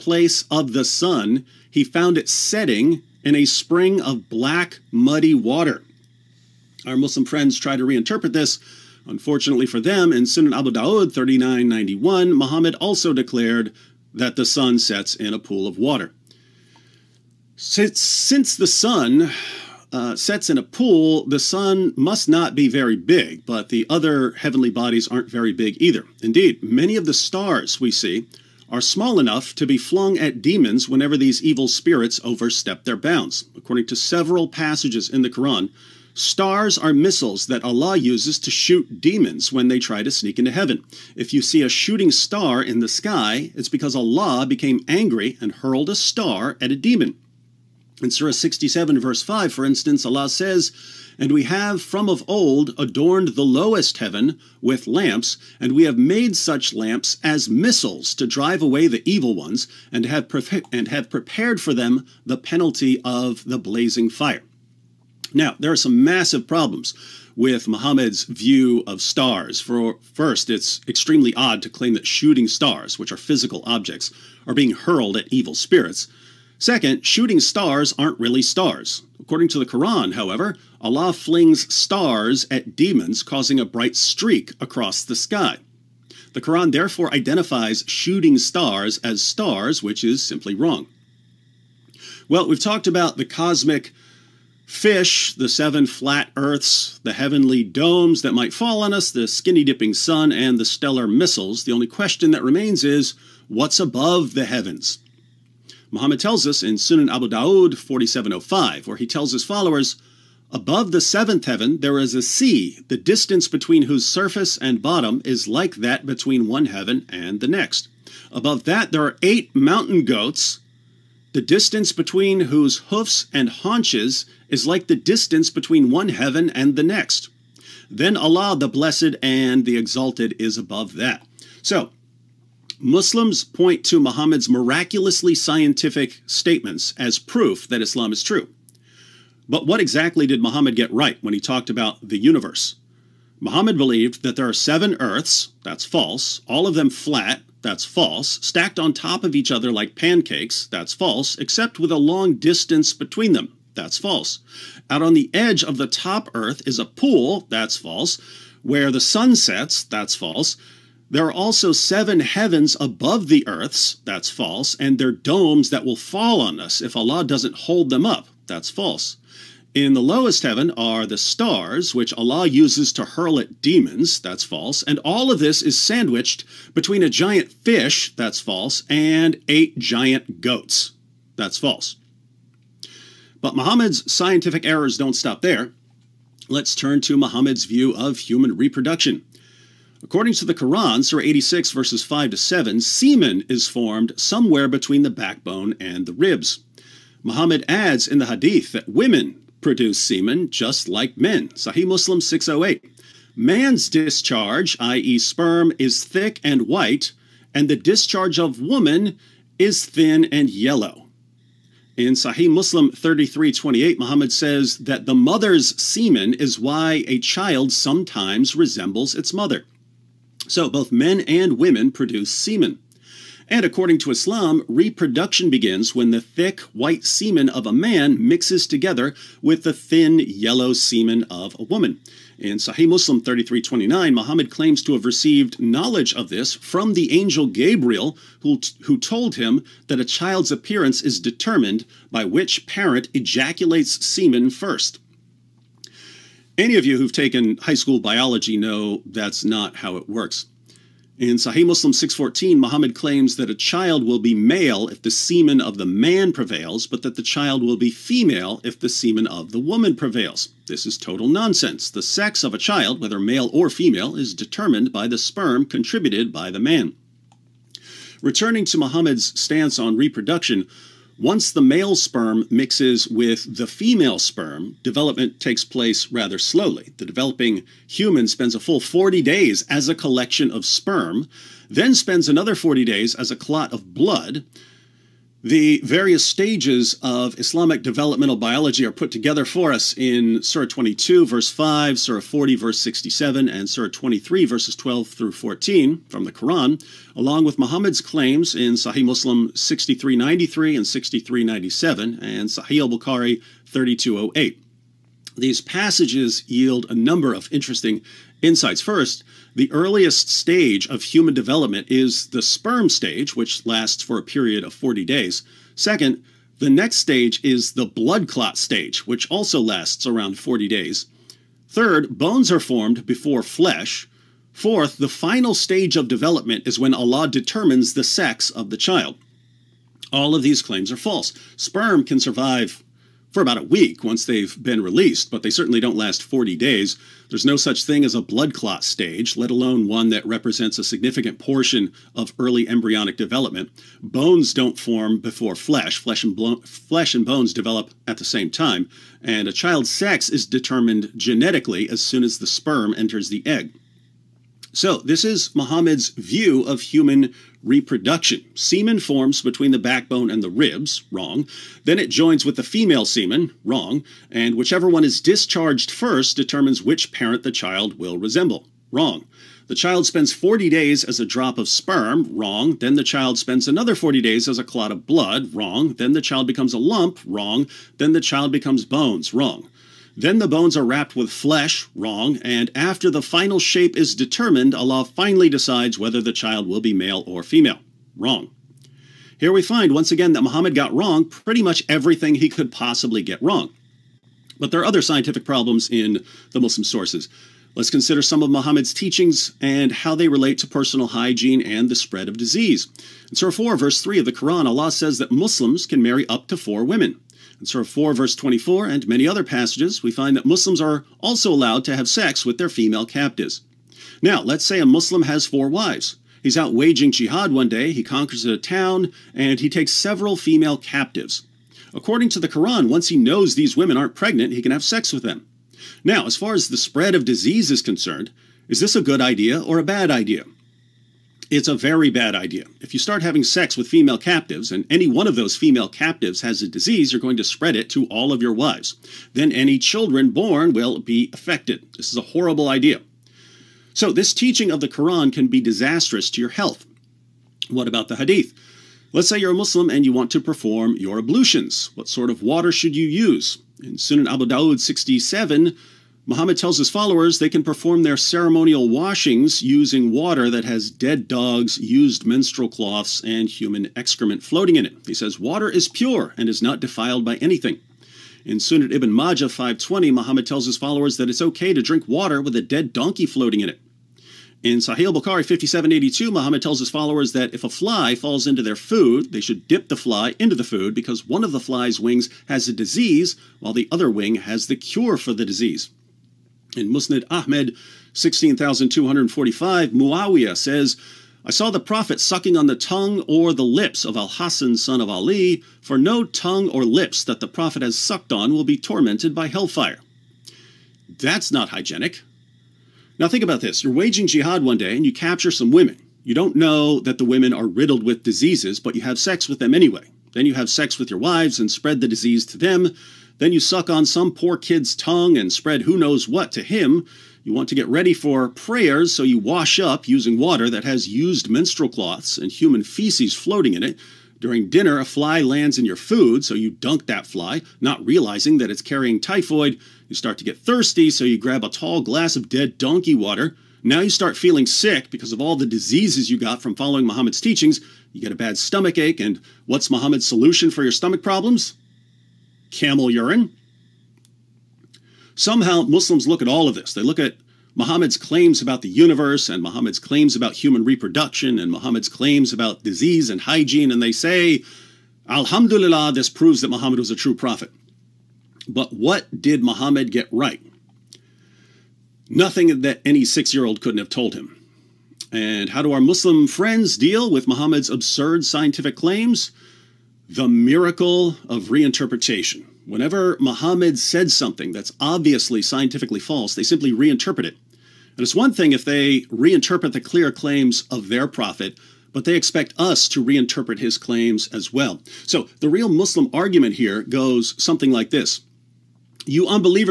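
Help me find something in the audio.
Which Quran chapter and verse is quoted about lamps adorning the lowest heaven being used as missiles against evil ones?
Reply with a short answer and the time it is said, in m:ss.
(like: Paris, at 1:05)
Surah 67, verse 5, at 0:48.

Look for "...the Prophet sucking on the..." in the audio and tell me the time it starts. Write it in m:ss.
8:11.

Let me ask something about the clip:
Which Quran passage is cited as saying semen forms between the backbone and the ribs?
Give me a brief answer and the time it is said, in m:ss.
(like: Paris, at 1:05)
Surah 86, verses 5 to 7, at 3:11.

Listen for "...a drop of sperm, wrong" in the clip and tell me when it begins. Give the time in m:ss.
6:11.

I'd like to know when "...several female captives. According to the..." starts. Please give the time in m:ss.
6:59.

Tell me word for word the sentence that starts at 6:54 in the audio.
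Now, let's say a Muslim has four wives.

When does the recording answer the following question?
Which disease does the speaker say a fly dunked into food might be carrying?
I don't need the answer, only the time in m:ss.
8:49.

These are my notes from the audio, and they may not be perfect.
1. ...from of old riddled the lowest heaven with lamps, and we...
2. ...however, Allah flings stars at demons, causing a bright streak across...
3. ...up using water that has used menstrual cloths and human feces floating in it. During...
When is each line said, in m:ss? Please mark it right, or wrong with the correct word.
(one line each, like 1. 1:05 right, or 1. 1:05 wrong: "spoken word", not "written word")
1. 0:51 wrong: "adorned", not "riddled"
2. 1:20 right
3. 8:39 right.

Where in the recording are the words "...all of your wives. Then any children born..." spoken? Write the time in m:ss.
7:18.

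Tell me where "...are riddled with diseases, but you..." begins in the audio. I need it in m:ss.
8:27.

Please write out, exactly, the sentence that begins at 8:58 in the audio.
You get a bad stomach ache, and what's Muhammad's solution for your stomach problems?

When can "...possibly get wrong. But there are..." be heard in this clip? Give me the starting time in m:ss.
6:32.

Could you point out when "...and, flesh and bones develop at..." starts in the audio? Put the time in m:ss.
5:46.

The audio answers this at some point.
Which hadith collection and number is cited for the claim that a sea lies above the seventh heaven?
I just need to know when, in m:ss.
1:46.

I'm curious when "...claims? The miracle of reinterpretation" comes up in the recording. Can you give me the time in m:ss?
9:28.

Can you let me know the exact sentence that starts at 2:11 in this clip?
So, Muslims point to Muhammad's miraculously scientific statements as proof that Islam is true.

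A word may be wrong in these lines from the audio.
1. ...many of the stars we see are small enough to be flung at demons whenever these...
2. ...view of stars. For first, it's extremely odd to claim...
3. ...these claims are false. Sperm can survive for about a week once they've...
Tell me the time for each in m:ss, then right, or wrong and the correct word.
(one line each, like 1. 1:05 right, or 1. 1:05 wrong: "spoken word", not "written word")
1. 0:26 right
2. 1:08 right
3. 5:30 right.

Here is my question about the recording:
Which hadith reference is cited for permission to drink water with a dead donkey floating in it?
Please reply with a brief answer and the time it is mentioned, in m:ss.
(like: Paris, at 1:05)
Sunan ibn Majah 520, at 7:48.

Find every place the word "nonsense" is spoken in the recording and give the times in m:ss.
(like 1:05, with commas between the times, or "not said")
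4:21.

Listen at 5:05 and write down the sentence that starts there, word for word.
These passages yield a number of interesting insights.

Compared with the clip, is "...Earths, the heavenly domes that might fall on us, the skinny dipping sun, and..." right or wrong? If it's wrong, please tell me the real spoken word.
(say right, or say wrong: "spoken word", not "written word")
right.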